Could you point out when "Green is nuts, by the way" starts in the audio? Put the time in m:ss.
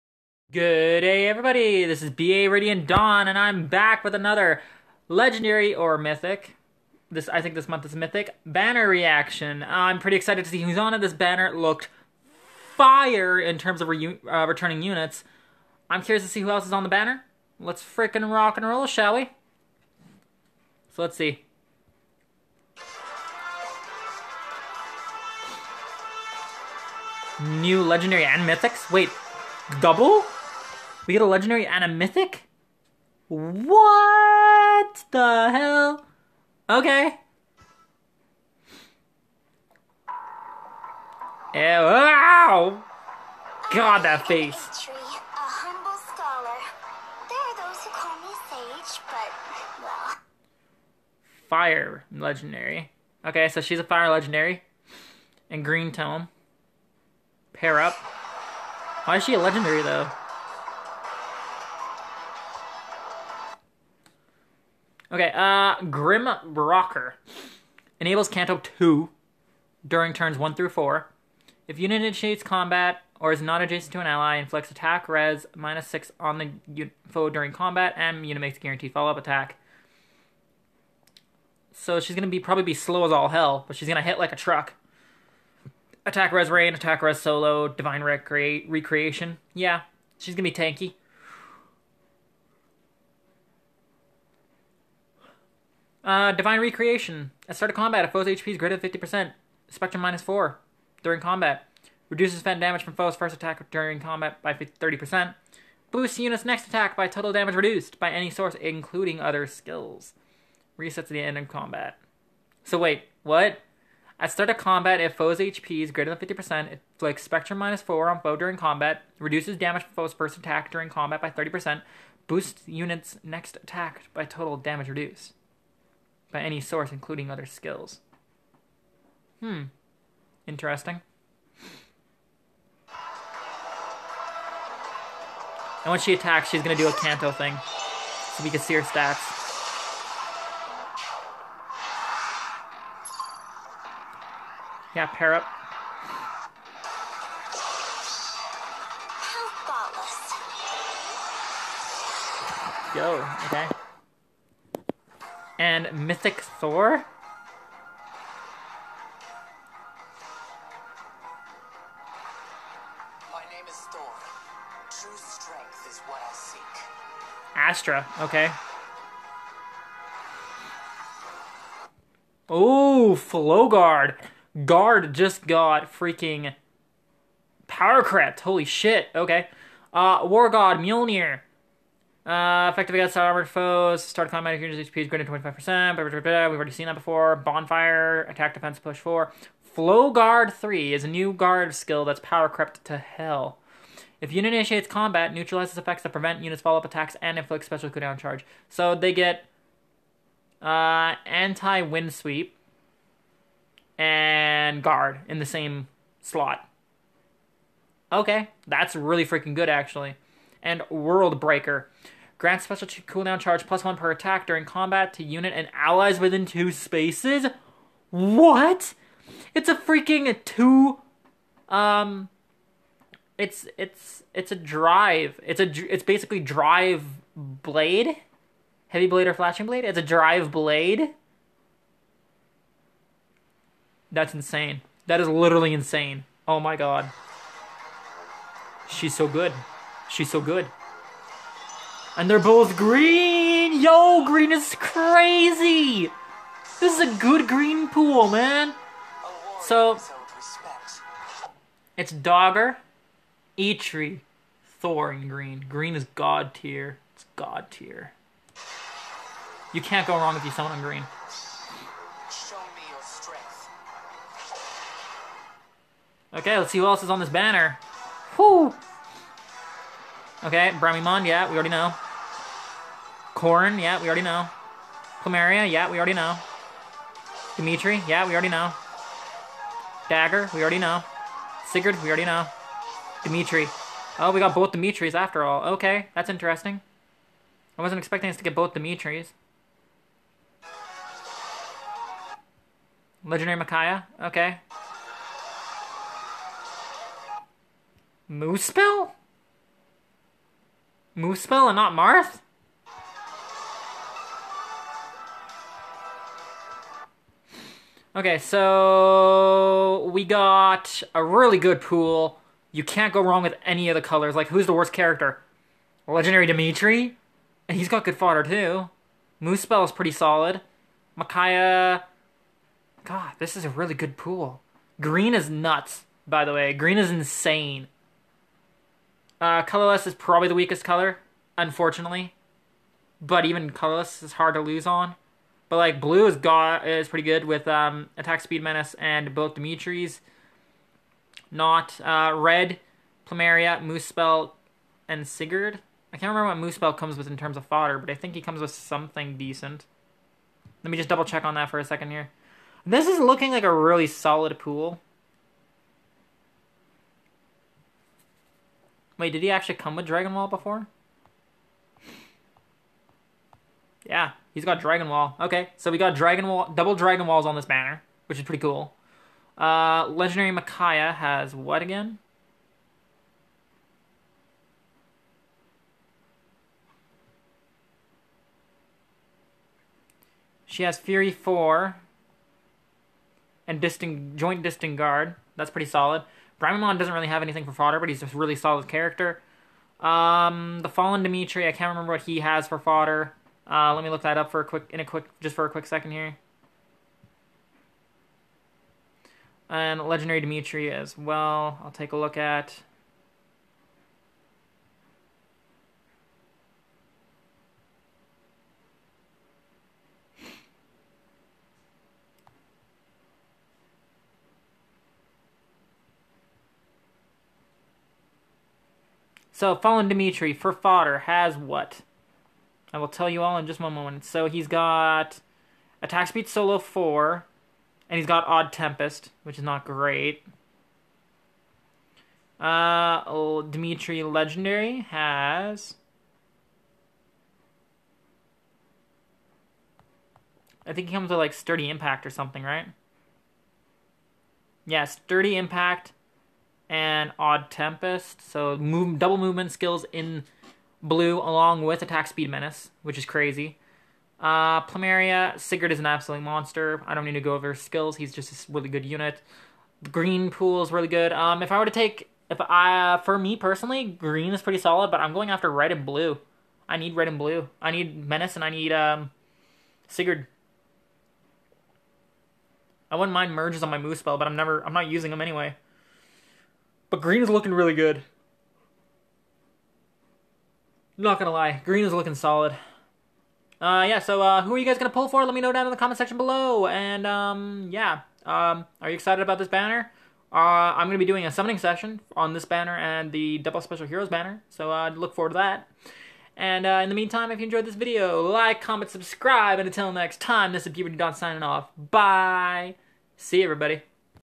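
5:24.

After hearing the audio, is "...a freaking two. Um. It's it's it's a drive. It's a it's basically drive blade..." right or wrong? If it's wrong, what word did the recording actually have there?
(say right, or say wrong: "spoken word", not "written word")
right.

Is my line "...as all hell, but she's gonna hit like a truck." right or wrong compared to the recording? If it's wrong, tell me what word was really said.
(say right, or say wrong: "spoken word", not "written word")
right.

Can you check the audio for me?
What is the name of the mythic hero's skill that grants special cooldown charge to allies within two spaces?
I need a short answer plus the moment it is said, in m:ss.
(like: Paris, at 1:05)
World Breaker, at 3:30.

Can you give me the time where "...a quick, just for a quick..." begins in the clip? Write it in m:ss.
6:34.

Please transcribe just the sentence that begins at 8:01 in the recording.
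Not gonna lie, green is looking solid.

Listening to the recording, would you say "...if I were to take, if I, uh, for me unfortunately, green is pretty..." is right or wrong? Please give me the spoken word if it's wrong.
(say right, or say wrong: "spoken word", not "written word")
wrong: "personally", not "unfortunately".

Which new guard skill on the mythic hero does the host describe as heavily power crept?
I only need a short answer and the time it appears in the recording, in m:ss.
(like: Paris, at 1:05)
Flow Guard 3, at 3:09.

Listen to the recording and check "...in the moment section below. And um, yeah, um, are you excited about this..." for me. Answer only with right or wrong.
wrong.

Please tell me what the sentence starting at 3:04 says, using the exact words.
Start climatic units HP is greater than 25%.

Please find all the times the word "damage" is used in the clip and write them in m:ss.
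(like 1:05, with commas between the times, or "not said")
1:42, 1:47, 1:59, 2:04.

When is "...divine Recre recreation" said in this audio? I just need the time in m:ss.
1:27.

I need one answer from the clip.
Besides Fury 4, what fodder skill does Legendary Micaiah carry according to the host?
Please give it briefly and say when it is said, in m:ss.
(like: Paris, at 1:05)
Joint Distant Guard, at 6:24.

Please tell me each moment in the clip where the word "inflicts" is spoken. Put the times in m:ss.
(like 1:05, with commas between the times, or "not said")
1:14, 3:17.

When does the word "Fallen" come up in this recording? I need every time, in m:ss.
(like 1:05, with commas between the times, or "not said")
6:30, 6:59.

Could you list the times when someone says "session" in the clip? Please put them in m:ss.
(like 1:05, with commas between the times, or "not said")
8:11.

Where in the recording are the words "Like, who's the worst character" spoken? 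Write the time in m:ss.
5:14.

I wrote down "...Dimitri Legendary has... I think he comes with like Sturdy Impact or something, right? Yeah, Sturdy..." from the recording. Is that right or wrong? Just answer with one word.
right.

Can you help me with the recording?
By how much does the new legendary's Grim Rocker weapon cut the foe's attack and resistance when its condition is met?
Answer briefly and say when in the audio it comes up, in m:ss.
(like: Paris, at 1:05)
6, at 1:14.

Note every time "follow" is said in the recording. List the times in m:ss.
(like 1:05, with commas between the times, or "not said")
1:18, 3:16.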